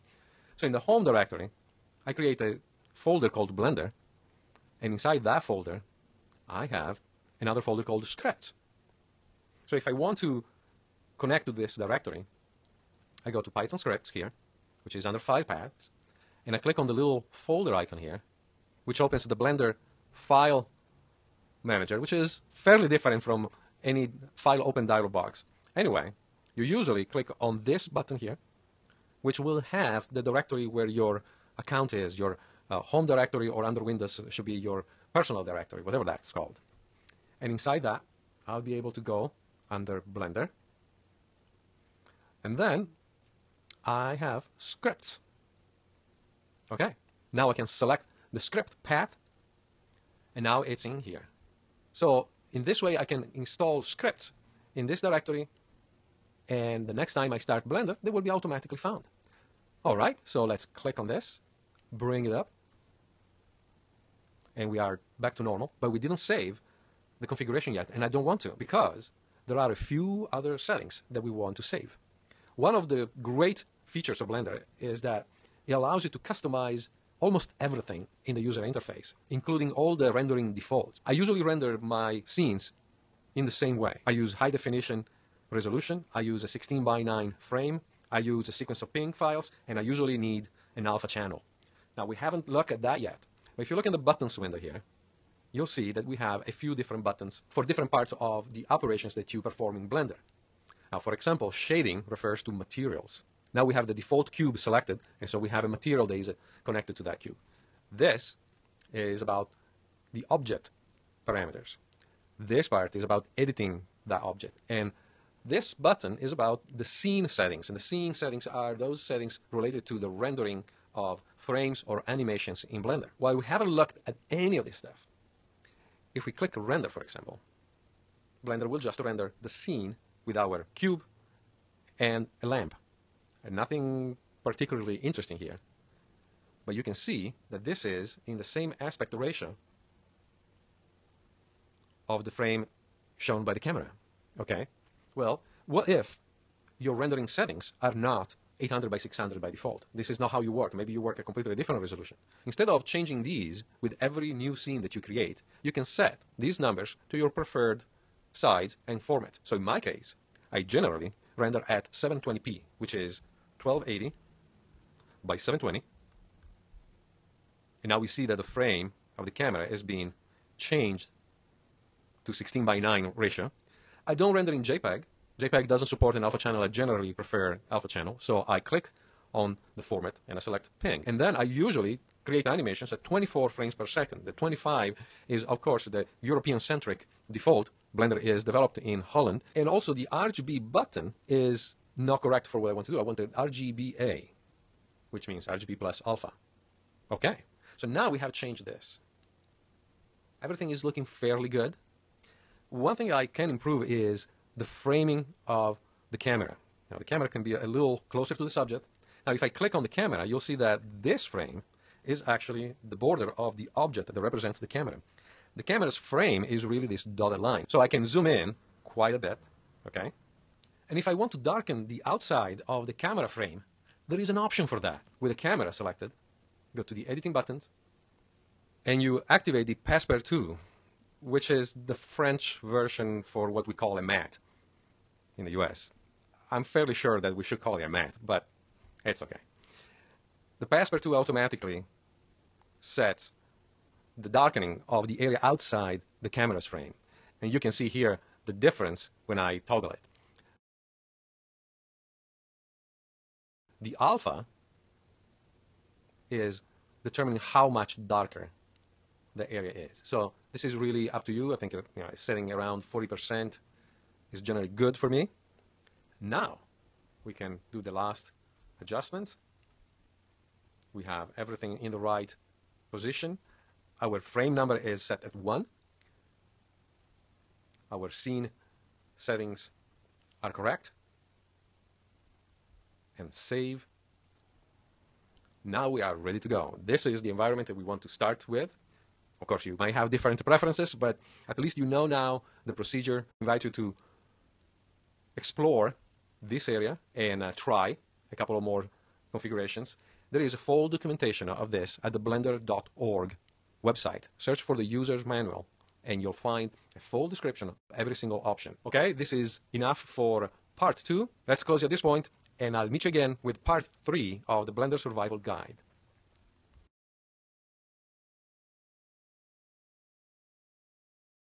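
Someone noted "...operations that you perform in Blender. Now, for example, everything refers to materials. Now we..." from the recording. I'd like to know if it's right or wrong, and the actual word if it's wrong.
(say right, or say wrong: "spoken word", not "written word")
wrong: "shading", not "everything".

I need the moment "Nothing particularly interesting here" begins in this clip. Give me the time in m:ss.
2:13.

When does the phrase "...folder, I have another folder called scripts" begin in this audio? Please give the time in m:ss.
0:05.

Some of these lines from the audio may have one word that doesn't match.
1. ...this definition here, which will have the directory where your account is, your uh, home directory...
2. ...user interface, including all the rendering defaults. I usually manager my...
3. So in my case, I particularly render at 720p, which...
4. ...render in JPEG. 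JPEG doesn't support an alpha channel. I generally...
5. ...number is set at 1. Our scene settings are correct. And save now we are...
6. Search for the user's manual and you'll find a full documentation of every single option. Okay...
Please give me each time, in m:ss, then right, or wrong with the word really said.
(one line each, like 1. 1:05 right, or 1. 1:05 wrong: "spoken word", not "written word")
1. 0:27 wrong: "button", not "definition"
2. 1:18 wrong: "render", not "manager"
3. 2:39 wrong: "generally", not "particularly"
4. 2:54 right
5. 4:34 right
6. 5:04 wrong: "description", not "documentation".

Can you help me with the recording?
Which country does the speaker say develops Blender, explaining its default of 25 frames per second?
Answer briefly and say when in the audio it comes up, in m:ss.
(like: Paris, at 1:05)
Holland, at 3:09.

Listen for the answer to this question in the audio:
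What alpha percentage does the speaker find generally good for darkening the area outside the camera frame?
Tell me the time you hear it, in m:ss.
4:22.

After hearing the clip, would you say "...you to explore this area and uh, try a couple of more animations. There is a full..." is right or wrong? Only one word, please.
wrong.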